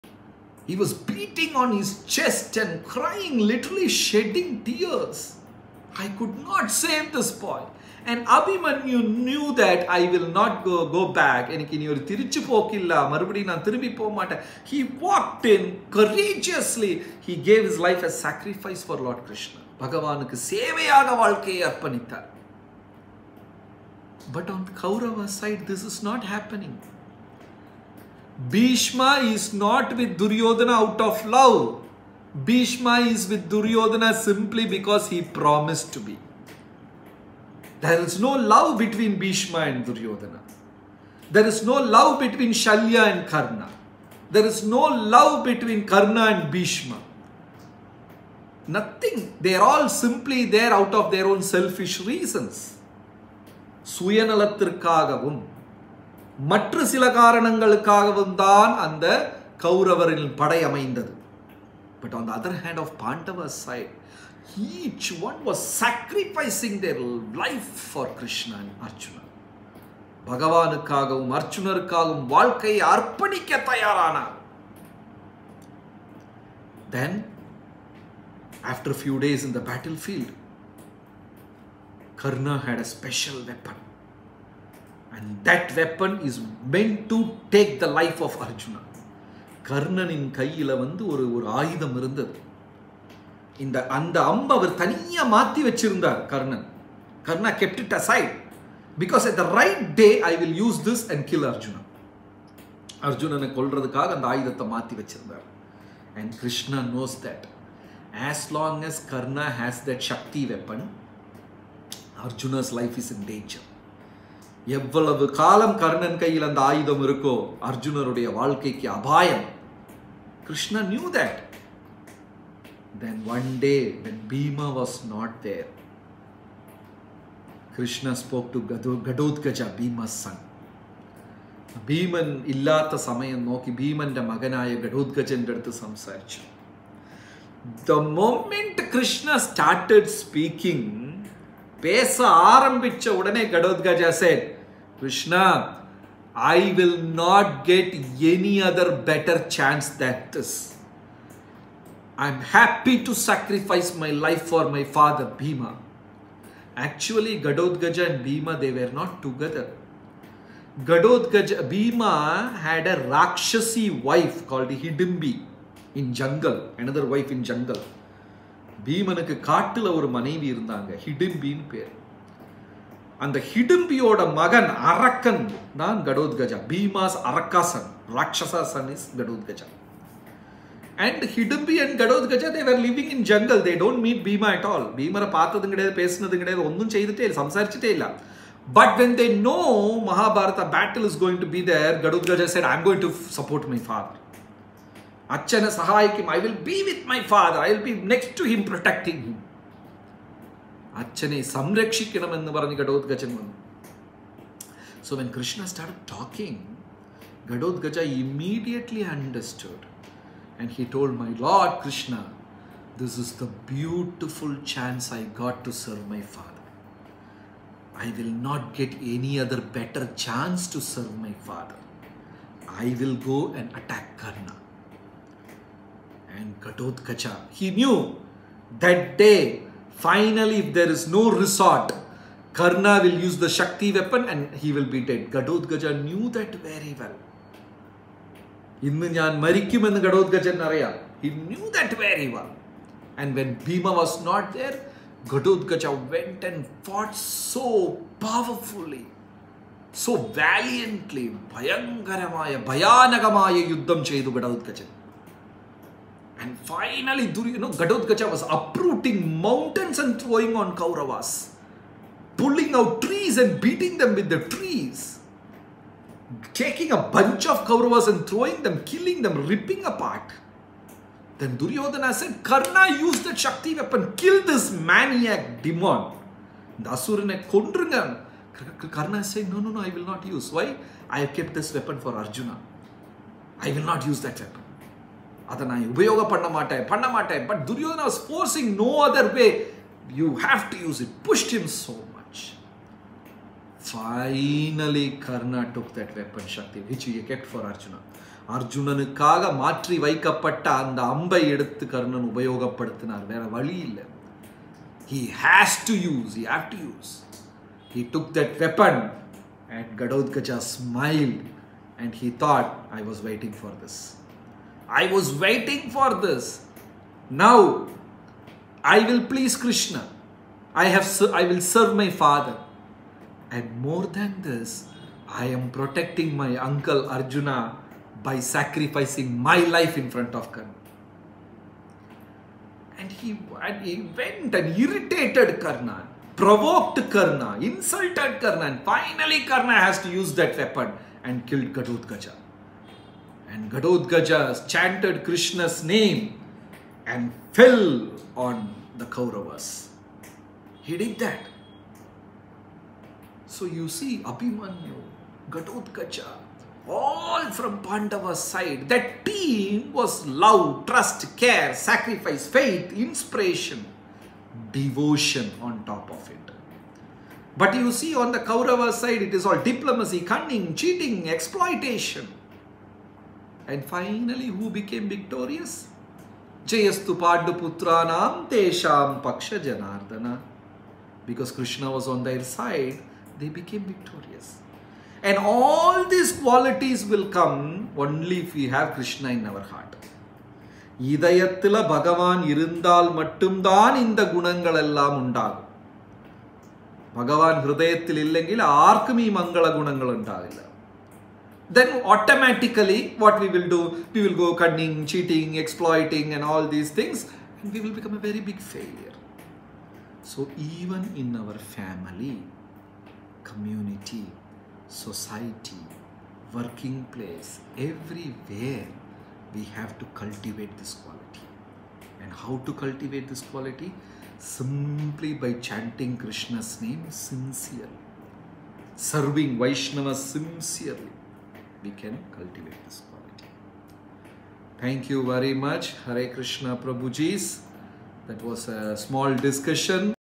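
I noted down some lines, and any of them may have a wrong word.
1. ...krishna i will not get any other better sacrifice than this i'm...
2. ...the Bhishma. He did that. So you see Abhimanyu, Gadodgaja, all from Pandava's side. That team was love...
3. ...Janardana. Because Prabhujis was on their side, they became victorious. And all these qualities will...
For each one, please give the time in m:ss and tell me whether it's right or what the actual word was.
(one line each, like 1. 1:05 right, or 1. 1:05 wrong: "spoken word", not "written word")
1. 2:24 wrong: "chance", not "sacrifice"
2. 5:48 wrong: "Kauravas", not "Bhishma"
3. 6:19 wrong: "Krishna", not "Prabhujis".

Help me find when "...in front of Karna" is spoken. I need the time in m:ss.
5:29.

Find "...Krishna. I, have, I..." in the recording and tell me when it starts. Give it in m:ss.
5:19.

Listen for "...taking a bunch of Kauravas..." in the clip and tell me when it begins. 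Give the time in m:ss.
4:26.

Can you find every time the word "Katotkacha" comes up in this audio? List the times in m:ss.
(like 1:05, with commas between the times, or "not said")
3:46, 3:55.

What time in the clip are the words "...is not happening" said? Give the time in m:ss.
0:25.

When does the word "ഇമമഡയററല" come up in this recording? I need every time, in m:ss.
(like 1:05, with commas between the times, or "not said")
3:28.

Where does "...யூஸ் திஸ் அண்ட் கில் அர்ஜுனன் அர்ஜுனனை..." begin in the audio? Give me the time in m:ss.
1:40.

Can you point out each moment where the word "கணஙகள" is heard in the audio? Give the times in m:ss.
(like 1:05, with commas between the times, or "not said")
6:34, 6:39.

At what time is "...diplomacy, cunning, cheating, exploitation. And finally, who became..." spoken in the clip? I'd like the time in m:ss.
6:09.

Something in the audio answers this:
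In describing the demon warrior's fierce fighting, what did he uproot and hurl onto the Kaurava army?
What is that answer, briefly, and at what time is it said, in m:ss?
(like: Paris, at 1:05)
Mountains, at 4:18.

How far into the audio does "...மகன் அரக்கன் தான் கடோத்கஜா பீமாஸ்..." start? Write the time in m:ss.
2:54.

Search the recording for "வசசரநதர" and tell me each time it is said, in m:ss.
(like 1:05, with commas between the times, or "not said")
1:35, 1:45.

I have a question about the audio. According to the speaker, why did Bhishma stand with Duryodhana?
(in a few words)
He promised to be.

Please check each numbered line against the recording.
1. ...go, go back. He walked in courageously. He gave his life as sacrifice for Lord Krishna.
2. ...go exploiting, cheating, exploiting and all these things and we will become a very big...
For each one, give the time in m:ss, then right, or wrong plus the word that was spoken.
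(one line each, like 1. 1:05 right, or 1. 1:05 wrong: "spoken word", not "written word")
1. 0:10 right
2. 6:44 wrong: "cunning", not "exploiting".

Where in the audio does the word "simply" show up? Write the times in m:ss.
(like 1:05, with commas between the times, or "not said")
0:34, 0:49, 7:04.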